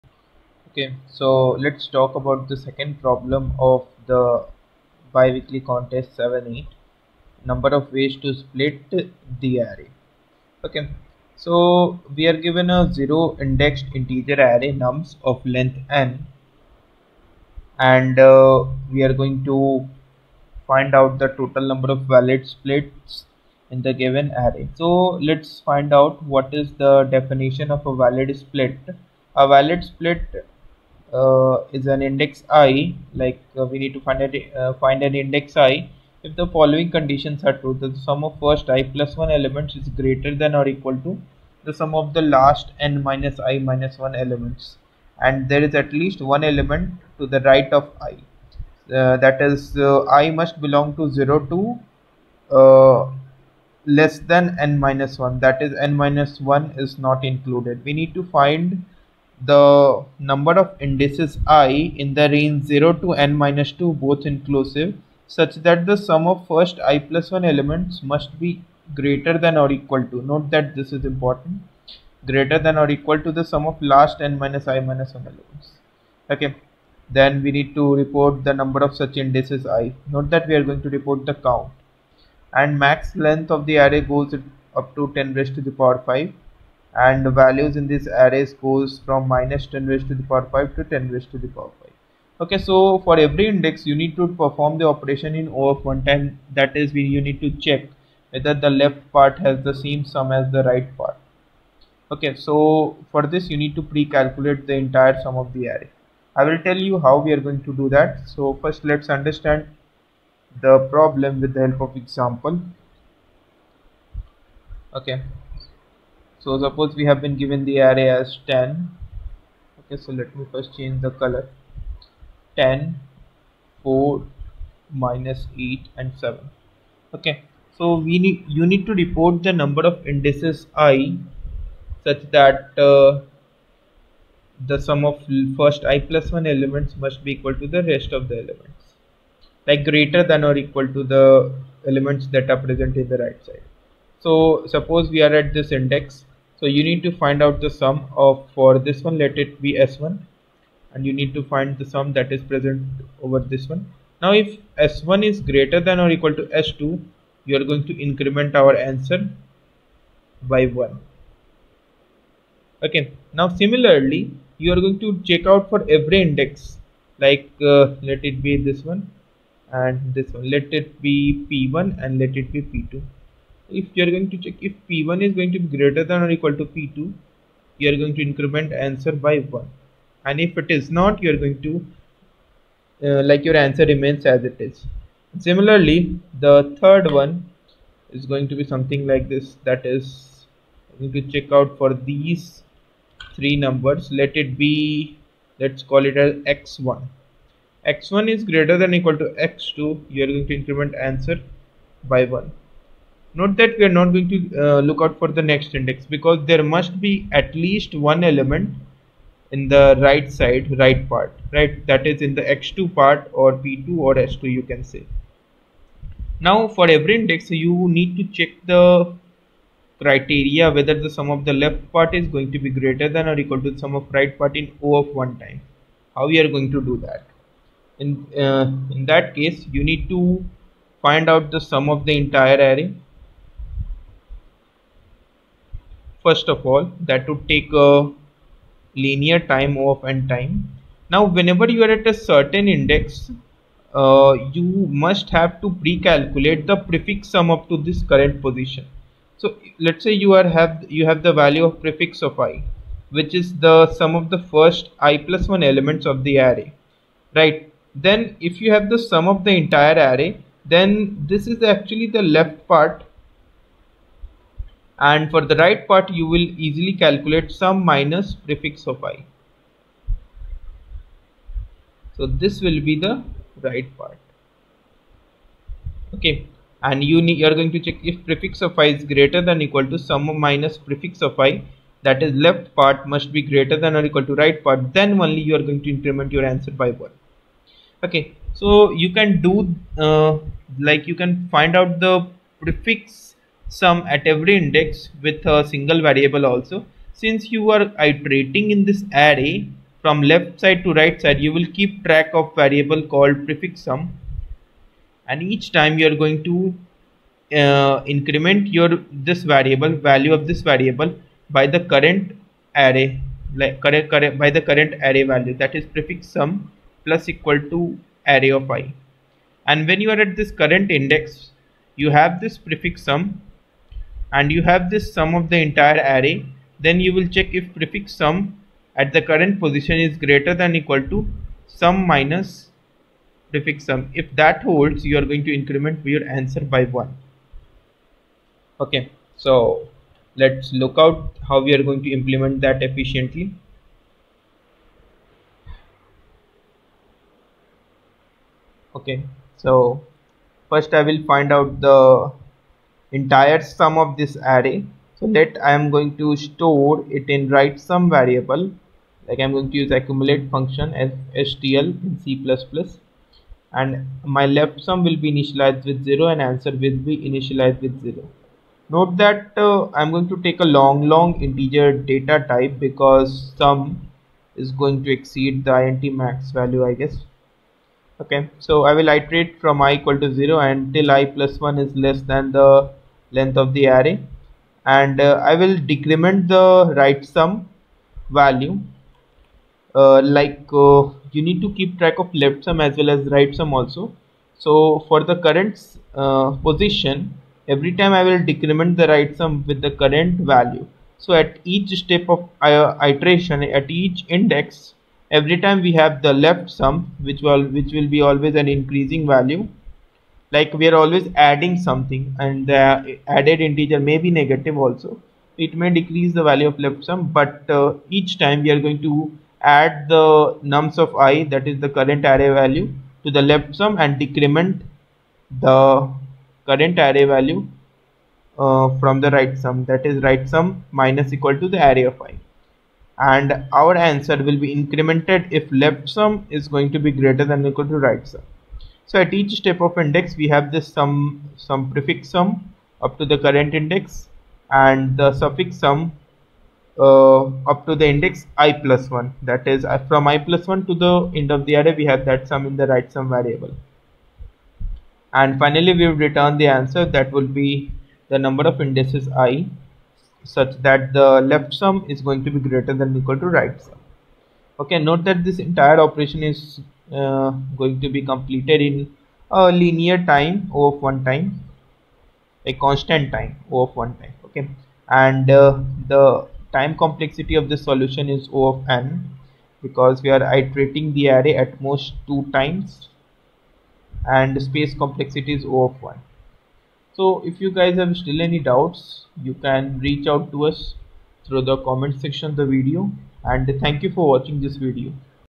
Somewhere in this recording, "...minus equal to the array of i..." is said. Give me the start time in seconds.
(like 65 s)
431 s.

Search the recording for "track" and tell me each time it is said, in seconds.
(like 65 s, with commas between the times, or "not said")
302 s, 391 s.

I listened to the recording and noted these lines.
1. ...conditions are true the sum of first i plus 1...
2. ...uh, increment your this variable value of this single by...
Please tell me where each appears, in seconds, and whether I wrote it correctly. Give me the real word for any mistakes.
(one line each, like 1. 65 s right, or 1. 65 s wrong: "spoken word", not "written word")
1. 36 s right
2. 307 s wrong: "variable", not "single".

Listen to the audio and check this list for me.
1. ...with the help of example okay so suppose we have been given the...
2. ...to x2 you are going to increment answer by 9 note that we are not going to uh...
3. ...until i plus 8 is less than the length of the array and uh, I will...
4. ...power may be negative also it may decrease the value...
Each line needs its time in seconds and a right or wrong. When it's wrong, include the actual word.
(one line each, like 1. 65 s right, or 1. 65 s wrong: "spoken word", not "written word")
1. 111 s right
2. 199 s wrong: "1", not "9"
3. 380 s wrong: "1", not "8"
4. 413 s wrong: "integer", not "power".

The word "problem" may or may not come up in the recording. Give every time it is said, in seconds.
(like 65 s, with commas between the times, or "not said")
3 s, 110 s.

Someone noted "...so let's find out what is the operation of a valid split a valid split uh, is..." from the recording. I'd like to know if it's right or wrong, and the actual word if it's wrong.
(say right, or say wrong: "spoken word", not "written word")
wrong: "definition", not "operation".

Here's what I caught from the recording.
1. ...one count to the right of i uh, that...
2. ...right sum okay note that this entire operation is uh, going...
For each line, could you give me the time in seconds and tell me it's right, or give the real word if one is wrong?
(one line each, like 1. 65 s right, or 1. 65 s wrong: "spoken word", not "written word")
1. 46 s wrong: "element", not "count"
2. 463 s right.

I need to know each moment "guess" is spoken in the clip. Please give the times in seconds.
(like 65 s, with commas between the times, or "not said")
376 s.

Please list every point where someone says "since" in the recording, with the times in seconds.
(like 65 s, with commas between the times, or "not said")
297 s.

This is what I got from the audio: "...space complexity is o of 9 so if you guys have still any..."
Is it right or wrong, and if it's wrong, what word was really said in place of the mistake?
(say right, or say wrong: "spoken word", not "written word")
wrong: "1", not "9".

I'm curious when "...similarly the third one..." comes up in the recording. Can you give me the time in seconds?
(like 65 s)
185 s.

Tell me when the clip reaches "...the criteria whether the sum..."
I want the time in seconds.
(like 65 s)
218 s.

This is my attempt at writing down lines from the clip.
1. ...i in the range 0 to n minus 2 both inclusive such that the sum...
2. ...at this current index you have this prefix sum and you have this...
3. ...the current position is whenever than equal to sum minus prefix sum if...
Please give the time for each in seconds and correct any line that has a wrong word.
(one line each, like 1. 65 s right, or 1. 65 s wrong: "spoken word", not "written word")
1. 61 s right
2. 320 s right
3. 329 s wrong: "greater", not "whenever".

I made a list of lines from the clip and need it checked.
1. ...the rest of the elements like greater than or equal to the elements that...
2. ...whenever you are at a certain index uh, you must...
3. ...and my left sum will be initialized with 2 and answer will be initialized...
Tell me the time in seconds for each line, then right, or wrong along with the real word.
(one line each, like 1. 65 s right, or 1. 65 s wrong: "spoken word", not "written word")
1. 137 s right
2. 241 s right
3. 363 s wrong: "0", not "2".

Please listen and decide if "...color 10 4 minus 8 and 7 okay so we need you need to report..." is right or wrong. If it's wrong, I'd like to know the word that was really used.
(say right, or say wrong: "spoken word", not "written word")
right.